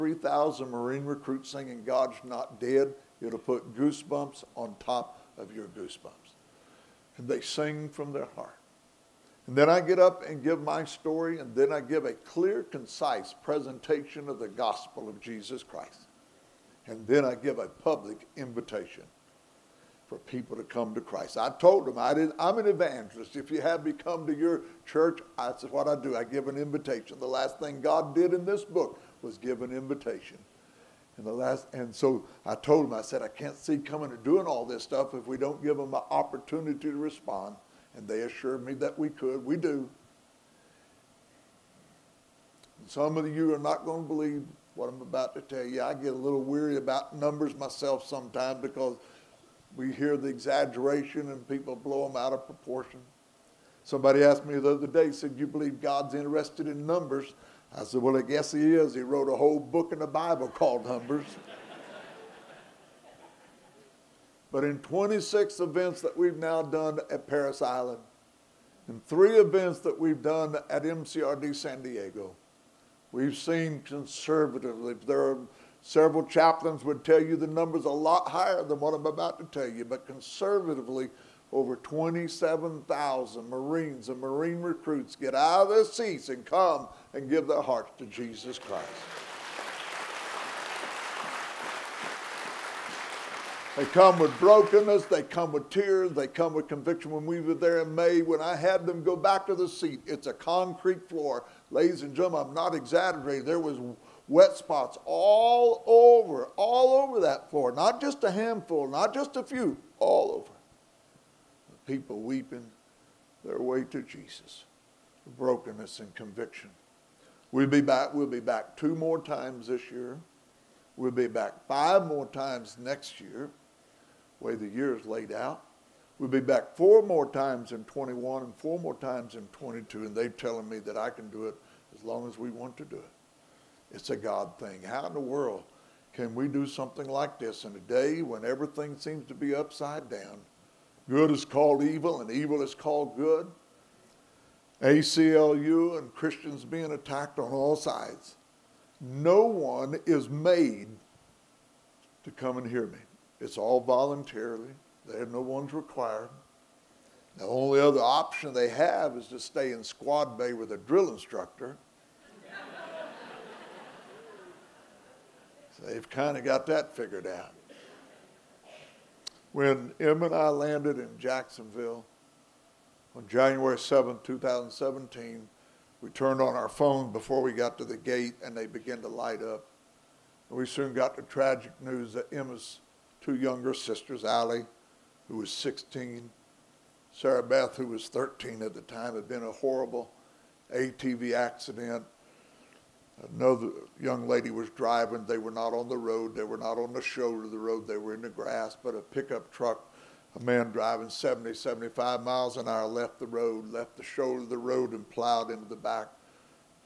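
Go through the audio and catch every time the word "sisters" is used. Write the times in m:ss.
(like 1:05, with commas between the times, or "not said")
3:03.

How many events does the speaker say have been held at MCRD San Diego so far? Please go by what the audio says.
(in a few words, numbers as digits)
3.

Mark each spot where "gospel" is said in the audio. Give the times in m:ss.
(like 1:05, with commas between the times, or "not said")
0:14.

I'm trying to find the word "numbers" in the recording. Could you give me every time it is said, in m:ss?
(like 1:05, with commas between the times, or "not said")
0:47, 0:56, 1:00, 1:17.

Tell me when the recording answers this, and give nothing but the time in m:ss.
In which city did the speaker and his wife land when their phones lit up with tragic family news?
2:51.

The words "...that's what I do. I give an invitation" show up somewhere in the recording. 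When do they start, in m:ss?
0:25.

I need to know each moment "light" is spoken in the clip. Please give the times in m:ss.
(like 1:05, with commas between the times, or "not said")
2:59.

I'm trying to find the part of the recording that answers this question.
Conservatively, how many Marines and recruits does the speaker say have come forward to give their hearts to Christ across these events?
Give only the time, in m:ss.
1:21.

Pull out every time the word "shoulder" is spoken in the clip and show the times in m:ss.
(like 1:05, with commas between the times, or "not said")
3:17, 3:24.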